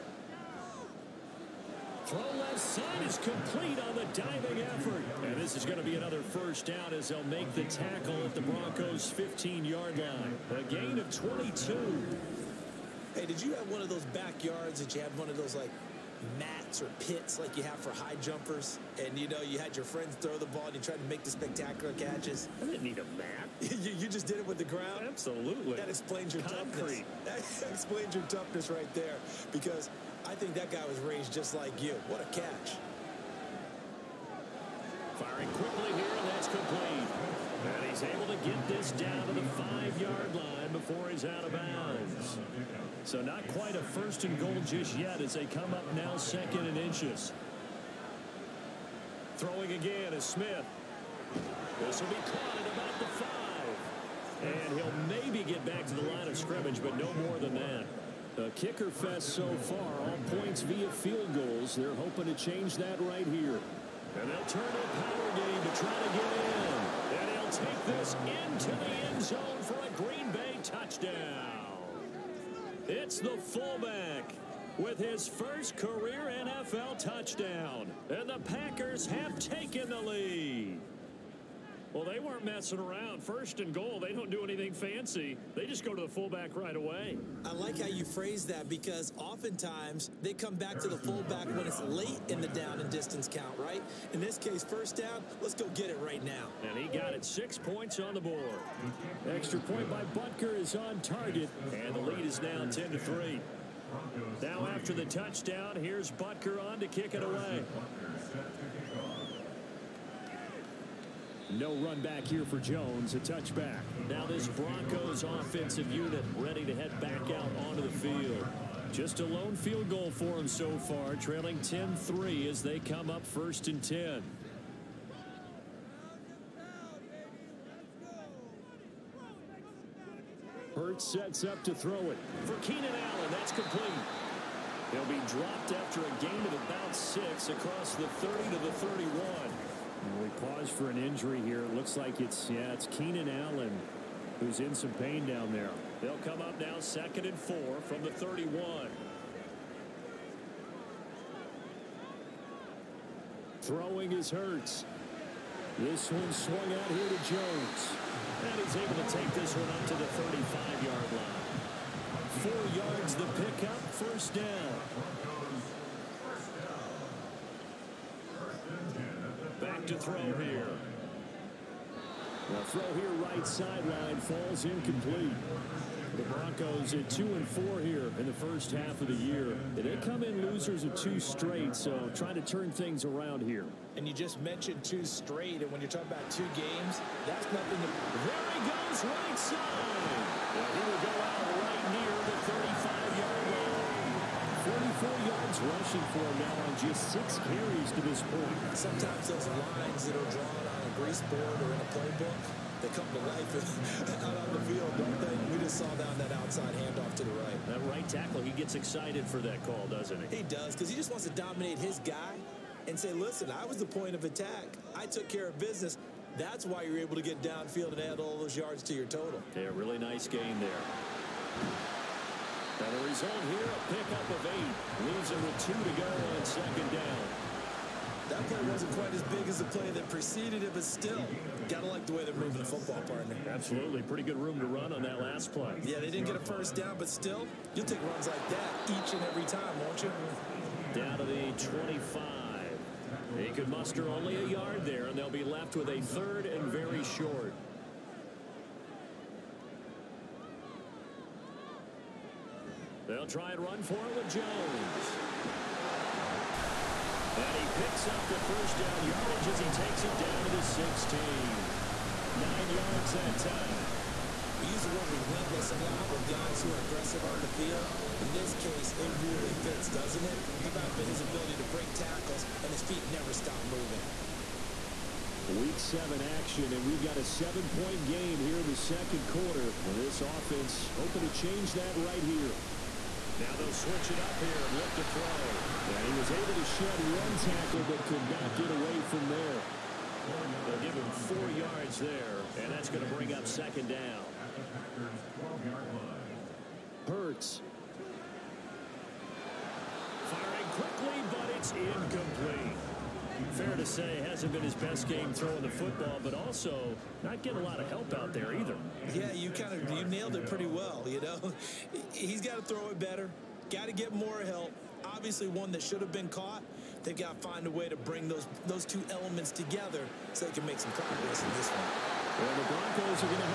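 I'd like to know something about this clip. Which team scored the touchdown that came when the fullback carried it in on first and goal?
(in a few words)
Green Bay.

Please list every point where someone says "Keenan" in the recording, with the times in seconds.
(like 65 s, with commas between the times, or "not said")
132 s, 142 s.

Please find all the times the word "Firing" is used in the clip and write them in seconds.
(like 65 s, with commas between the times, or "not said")
35 s, 300 s.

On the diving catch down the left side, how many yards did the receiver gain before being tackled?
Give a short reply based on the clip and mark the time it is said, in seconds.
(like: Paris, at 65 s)
22, at 10 s.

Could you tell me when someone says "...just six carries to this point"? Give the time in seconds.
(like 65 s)
196 s.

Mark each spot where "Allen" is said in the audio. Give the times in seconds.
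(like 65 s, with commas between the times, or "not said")
132 s, 143 s.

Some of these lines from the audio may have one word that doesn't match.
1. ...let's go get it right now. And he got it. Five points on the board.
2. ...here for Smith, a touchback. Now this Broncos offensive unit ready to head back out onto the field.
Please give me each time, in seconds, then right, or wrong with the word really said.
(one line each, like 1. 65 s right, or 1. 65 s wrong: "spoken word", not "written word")
1. 95 s wrong: "Six", not "Five"
2. 112 s wrong: "Jones", not "Smith".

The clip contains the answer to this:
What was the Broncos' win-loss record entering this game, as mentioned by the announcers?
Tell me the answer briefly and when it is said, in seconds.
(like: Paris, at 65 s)
2 and 4, at 177 s.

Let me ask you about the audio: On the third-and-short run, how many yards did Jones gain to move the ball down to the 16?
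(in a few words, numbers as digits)
9.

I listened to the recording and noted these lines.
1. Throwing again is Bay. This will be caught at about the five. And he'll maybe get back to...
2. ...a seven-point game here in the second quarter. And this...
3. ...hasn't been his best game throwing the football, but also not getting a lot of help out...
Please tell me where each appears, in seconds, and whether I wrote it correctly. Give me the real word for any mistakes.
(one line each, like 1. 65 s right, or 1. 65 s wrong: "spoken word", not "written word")
1. 49 s wrong: "Smith", not "Bay"
2. 277 s right
3. 304 s right.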